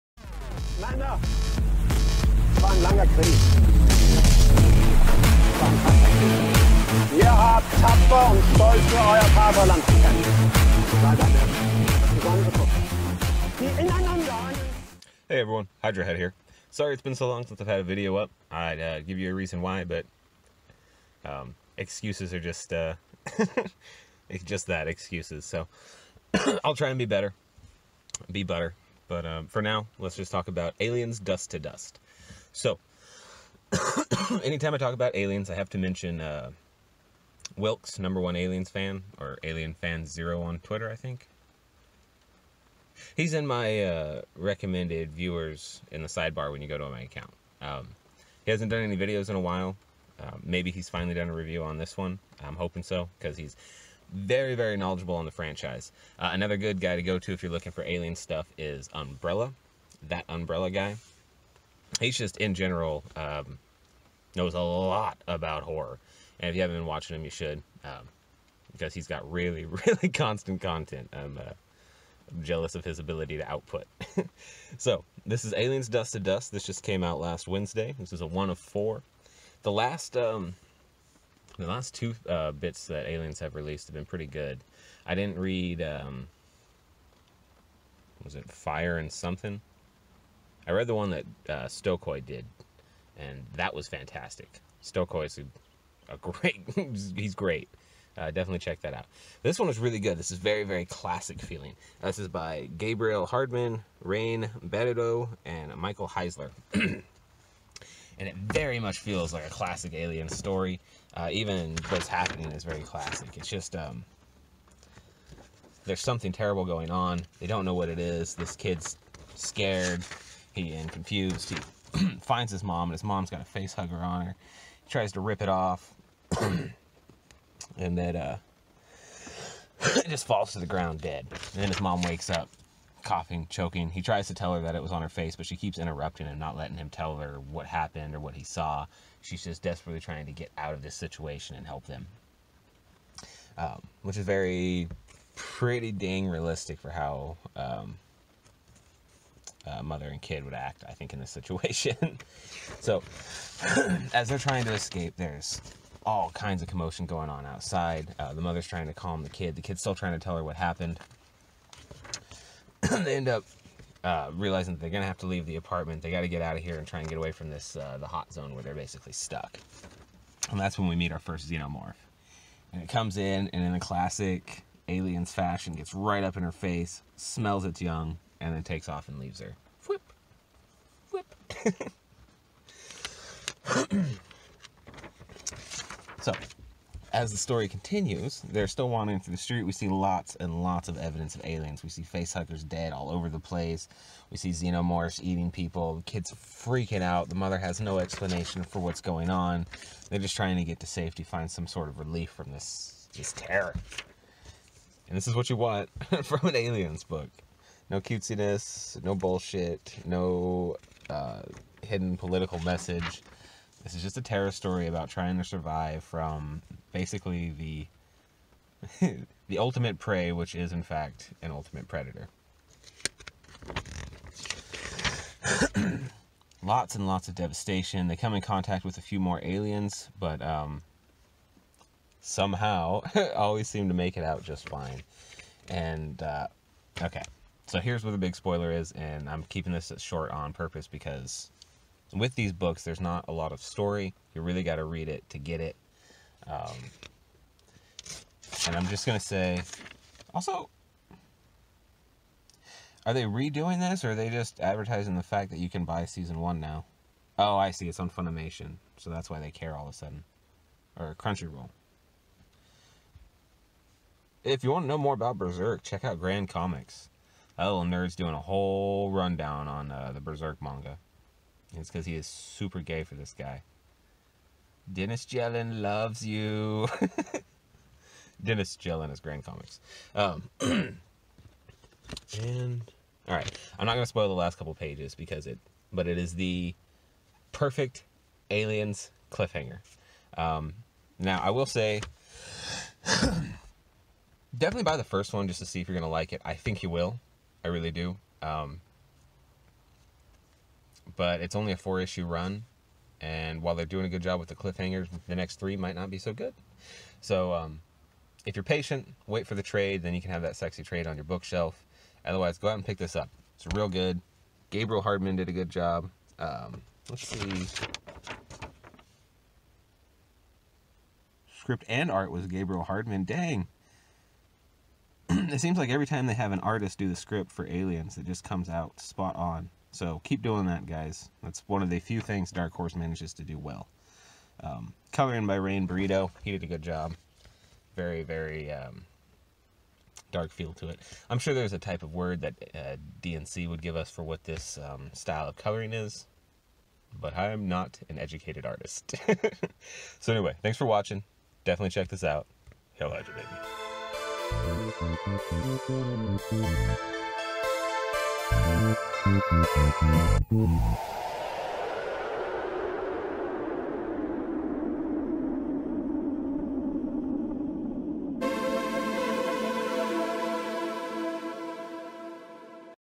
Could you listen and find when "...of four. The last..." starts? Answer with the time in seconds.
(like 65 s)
78 s.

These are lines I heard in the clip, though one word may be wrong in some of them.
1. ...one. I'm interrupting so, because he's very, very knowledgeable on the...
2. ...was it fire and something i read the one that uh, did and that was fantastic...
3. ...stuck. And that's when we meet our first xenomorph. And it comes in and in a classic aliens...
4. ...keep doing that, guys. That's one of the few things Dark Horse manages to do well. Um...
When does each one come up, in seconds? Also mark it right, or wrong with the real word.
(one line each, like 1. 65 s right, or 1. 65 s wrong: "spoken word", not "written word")
1. 51 s wrong: "hoping", not "interrupting"
2. 88 s right
3. 169 s right
4. 330 s right.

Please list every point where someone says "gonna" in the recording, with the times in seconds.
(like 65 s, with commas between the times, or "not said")
164 s, 283 s, 295 s.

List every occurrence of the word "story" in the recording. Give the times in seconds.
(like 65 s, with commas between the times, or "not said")
110 s, 187 s, 214 s, 243 s.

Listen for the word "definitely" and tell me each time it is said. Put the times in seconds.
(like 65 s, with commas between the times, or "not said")
98 s, 294 s, 351 s.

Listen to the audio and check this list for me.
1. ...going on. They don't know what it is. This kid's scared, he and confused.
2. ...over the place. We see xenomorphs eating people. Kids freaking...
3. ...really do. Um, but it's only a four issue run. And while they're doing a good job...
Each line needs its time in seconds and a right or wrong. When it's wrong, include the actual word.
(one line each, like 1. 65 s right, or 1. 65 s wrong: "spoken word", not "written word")
1. 116 s right
2. 193 s right
3. 297 s right.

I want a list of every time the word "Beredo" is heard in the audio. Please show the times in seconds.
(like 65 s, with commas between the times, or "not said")
104 s, 335 s.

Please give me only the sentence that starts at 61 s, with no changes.
He's just, in general, um, knows a lot about horror.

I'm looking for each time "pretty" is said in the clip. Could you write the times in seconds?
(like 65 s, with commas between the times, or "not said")
84 s, 145 s.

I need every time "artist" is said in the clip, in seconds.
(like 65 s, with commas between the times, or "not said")
326 s, 348 s.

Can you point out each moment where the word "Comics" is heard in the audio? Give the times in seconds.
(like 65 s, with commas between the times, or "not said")
266 s, 279 s.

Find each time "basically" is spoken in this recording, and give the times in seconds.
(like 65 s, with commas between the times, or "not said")
168 s, 216 s.